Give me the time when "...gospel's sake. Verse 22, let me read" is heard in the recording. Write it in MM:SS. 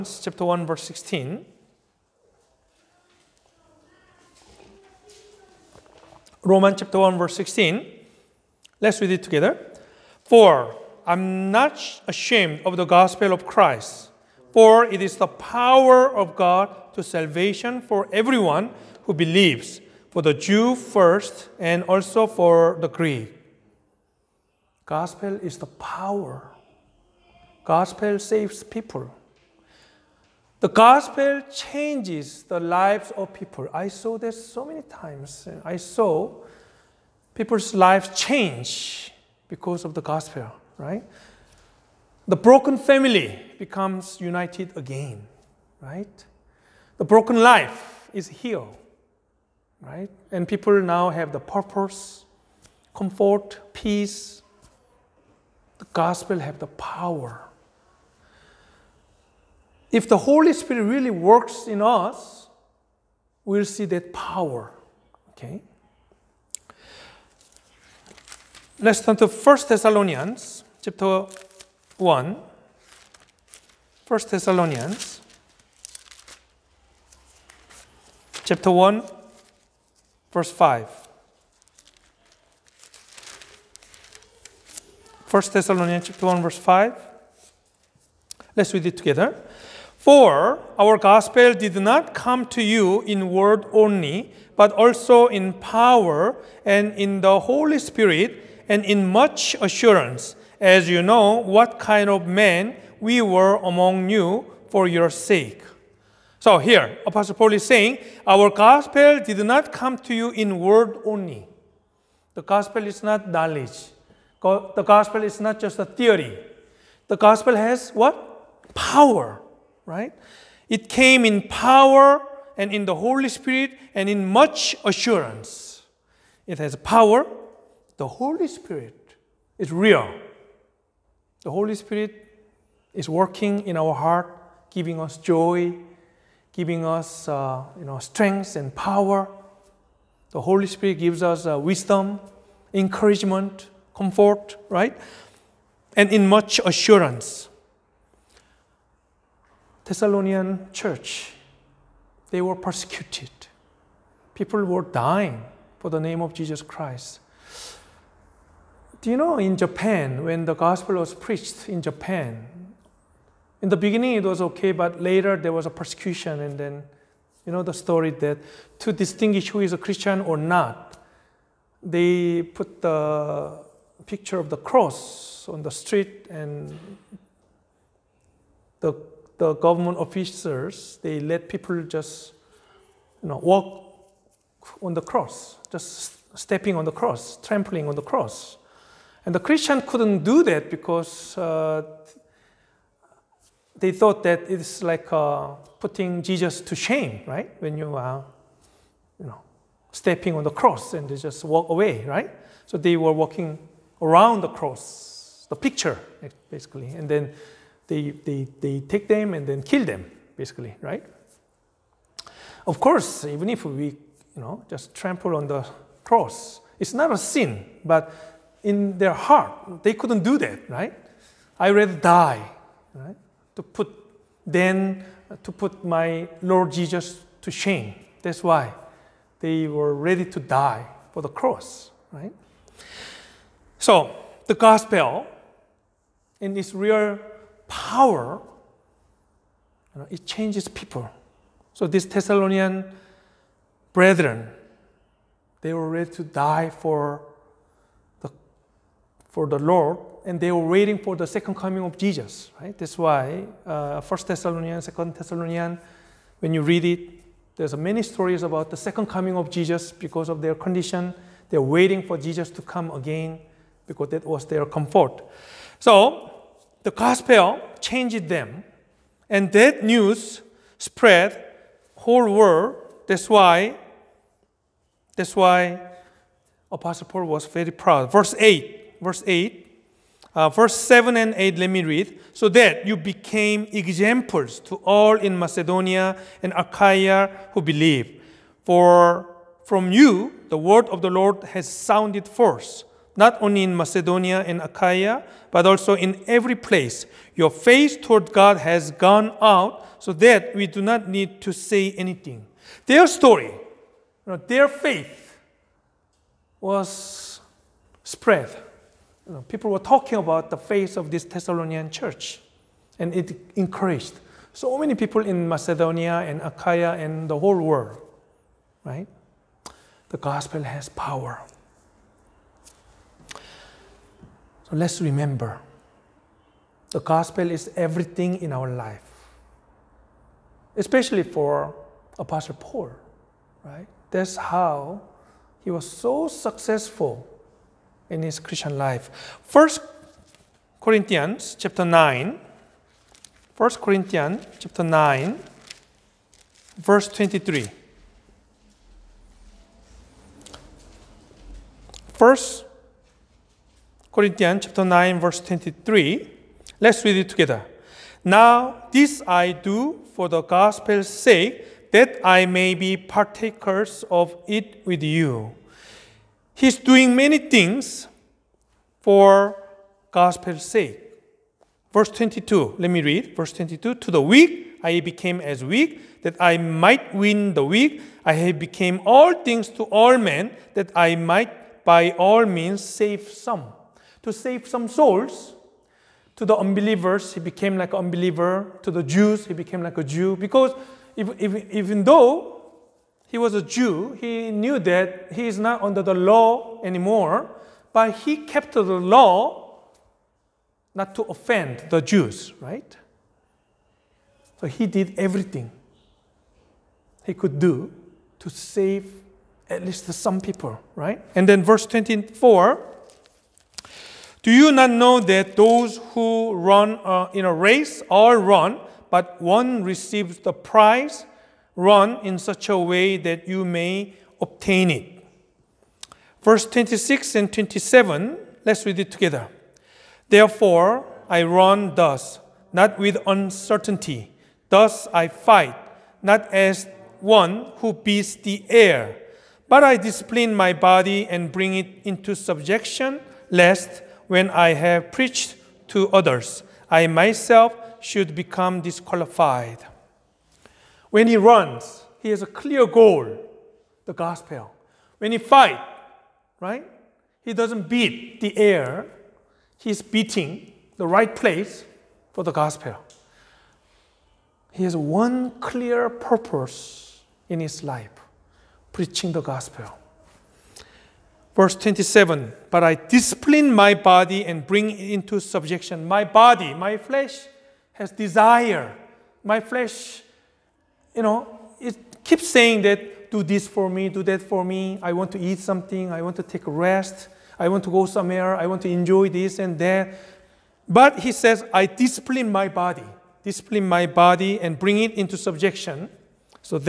06:10.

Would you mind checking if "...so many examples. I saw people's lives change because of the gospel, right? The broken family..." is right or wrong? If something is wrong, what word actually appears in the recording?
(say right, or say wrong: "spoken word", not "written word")
wrong: "times", not "examples".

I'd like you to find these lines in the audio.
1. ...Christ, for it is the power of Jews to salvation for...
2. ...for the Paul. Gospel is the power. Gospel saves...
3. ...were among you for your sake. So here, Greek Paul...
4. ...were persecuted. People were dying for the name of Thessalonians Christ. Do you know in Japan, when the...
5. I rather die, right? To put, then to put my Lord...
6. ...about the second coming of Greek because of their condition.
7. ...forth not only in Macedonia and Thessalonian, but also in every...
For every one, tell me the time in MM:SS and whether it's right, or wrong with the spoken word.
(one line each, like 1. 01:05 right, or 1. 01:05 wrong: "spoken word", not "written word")
1. 00:13 wrong: "God", not "Jews"
2. 00:22 wrong: "Greek", not "Paul"
3. 01:43 wrong: "Apostle", not "Greek"
4. 02:32 wrong: "Jesus", not "Thessalonians"
5. 03:41 right
6. 04:18 wrong: "Jesus", not "Greek"
7. 04:52 wrong: "Achaia", not "Thessalonian".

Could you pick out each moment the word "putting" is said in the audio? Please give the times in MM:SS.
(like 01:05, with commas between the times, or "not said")
03:15.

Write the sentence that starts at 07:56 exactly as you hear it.
My body, my flesh has desire.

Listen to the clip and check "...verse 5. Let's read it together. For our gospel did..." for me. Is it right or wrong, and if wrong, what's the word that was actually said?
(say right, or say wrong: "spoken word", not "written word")
right.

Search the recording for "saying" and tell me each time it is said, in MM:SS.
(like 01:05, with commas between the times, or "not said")
01:47, 08:02.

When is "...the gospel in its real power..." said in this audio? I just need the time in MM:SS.
03:54.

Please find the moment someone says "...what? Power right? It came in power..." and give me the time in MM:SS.
01:57.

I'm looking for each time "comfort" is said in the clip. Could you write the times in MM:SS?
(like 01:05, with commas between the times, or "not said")
00:52, 02:23, 04:24.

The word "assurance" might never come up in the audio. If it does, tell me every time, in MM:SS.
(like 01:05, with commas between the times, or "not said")
01:39, 02:04, 02:26.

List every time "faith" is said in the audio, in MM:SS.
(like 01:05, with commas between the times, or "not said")
04:57, 05:04, 05:10.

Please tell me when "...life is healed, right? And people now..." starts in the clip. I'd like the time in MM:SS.
00:47.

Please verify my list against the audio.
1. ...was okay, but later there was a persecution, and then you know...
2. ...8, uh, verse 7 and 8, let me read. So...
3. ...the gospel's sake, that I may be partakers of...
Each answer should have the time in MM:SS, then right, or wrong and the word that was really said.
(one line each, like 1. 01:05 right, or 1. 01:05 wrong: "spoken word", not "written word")
1. 02:44 right
2. 04:39 right
3. 06:00 right.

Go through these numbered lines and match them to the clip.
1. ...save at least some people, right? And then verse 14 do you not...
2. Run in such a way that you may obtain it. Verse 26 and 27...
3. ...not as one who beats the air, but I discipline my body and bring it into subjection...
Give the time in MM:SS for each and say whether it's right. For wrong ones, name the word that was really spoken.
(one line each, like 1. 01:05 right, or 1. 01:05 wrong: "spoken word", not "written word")
1. 06:48 wrong: "24", not "14"
2. 07:01 right
3. 07:16 right.